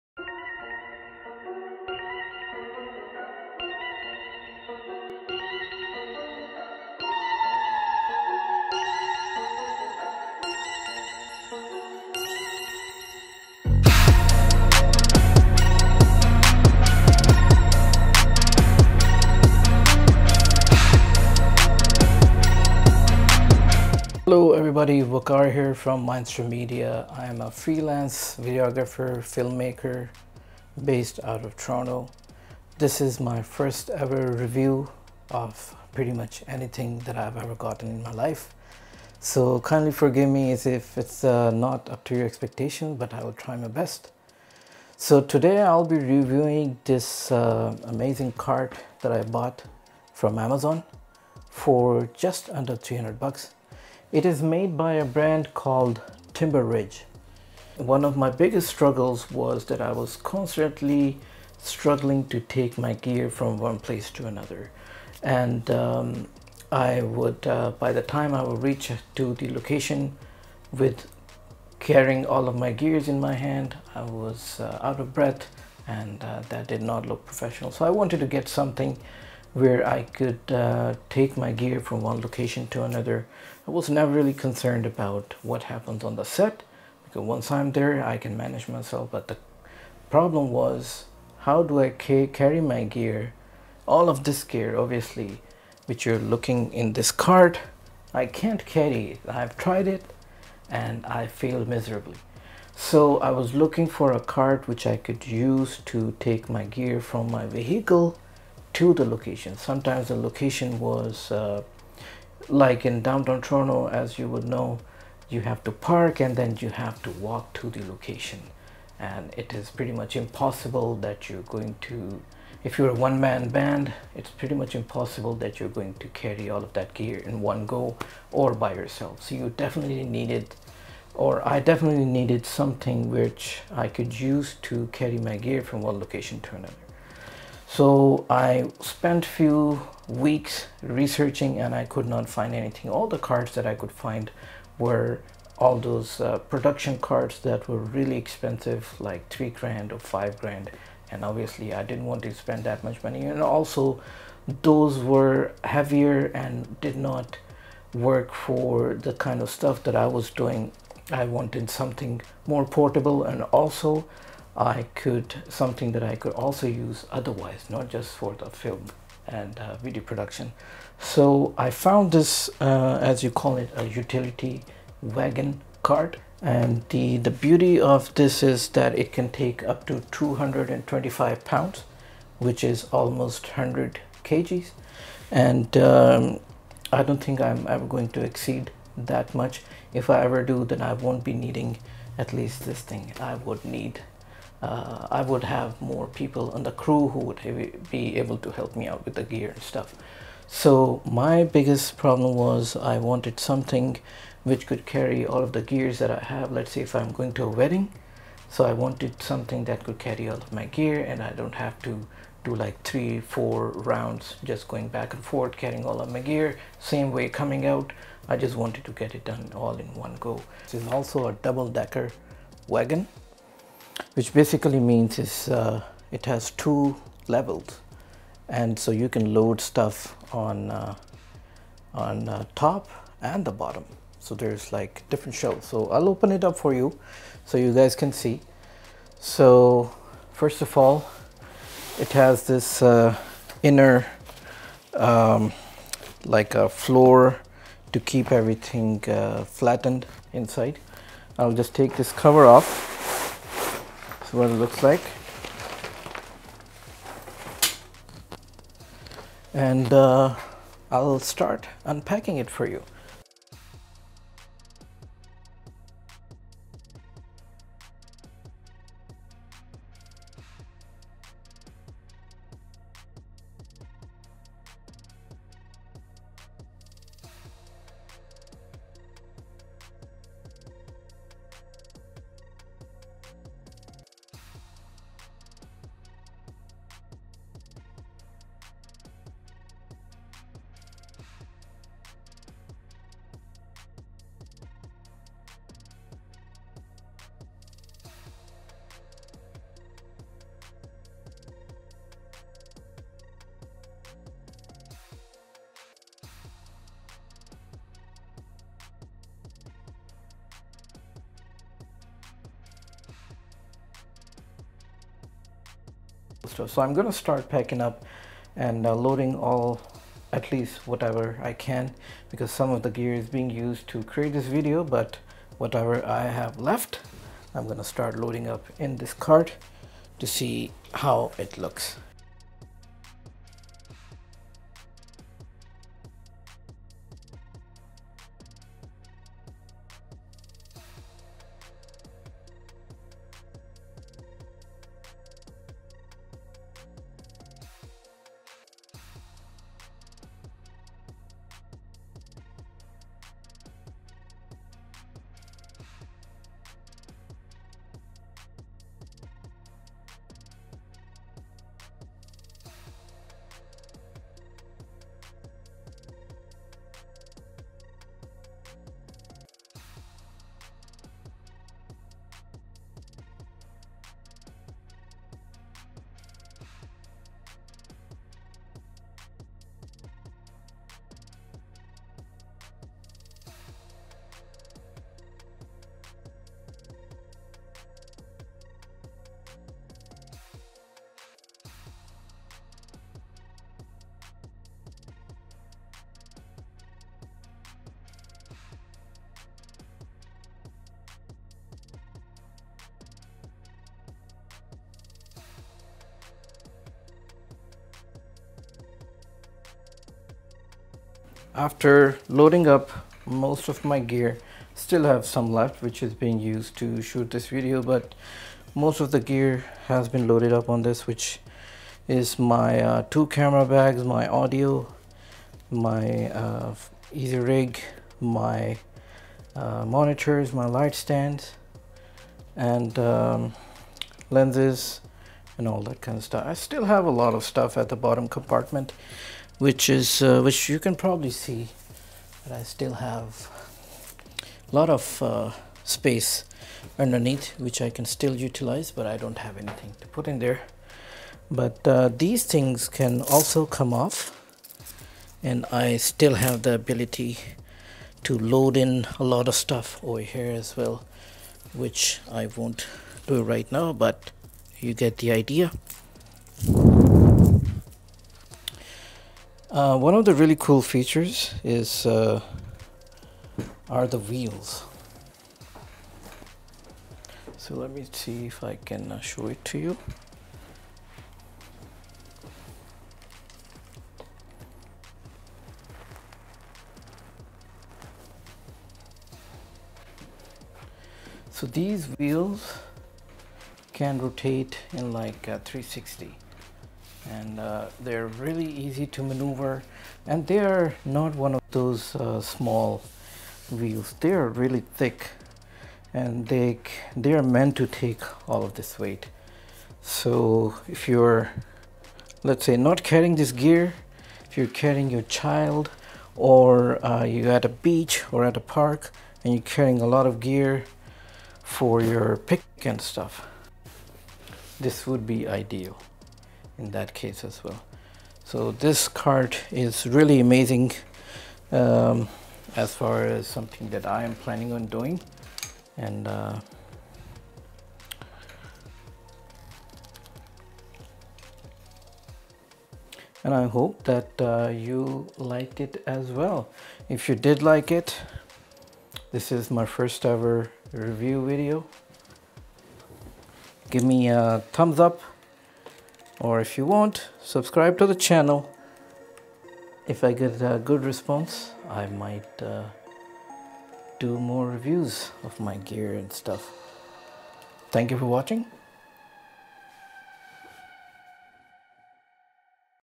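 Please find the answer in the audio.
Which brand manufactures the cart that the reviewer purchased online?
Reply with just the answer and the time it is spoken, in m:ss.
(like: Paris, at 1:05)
Timber Ridge, at 0:56.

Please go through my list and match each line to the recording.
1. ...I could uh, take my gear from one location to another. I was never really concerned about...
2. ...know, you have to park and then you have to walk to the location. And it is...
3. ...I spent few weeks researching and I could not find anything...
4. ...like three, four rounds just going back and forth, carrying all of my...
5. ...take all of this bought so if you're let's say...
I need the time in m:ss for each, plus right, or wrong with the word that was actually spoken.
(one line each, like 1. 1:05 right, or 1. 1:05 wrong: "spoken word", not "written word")
1. 1:19 right
2. 1:54 right
3. 2:18 right
4. 3:32 right
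5. 8:27 wrong: "weight", not "bought".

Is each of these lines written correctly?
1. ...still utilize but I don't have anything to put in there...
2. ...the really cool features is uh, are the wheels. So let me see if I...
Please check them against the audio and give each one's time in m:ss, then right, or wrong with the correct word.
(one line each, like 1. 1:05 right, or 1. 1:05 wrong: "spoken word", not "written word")
1. 7:28 right
2. 7:50 right.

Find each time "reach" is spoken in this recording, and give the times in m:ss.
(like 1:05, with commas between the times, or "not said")
1:08.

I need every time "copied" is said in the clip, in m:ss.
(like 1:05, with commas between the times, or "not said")
not said.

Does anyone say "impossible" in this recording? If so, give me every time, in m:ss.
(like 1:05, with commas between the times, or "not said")
2:00, 2:04.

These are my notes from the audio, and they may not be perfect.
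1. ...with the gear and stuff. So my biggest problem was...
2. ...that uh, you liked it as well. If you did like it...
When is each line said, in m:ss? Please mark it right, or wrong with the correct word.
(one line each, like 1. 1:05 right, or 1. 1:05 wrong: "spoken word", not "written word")
1. 3:19 right
2. 9:04 right.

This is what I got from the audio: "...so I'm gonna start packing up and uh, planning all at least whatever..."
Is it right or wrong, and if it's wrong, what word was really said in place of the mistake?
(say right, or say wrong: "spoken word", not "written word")
wrong: "loading", not "planning".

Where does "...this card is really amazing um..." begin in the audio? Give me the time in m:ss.
8:48.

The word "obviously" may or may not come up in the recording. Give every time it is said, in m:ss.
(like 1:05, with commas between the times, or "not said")
1:34, 2:31.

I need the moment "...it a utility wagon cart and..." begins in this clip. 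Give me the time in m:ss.
2:53.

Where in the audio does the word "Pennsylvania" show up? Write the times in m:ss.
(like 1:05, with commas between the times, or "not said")
not said.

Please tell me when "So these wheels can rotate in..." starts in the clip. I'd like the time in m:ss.
8:11.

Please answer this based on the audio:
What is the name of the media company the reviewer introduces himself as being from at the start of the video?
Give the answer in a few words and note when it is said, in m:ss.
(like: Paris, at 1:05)
Mindster Media, at 0:26.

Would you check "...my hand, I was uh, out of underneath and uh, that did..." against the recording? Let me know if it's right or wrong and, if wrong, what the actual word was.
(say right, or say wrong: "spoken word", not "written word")
wrong: "breath", not "underneath".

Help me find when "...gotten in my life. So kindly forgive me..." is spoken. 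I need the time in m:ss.
0:37.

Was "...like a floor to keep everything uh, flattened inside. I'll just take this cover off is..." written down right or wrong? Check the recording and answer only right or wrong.
right.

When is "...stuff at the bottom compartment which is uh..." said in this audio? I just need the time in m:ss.
7:17.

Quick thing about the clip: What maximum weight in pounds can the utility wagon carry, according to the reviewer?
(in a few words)
225 pounds.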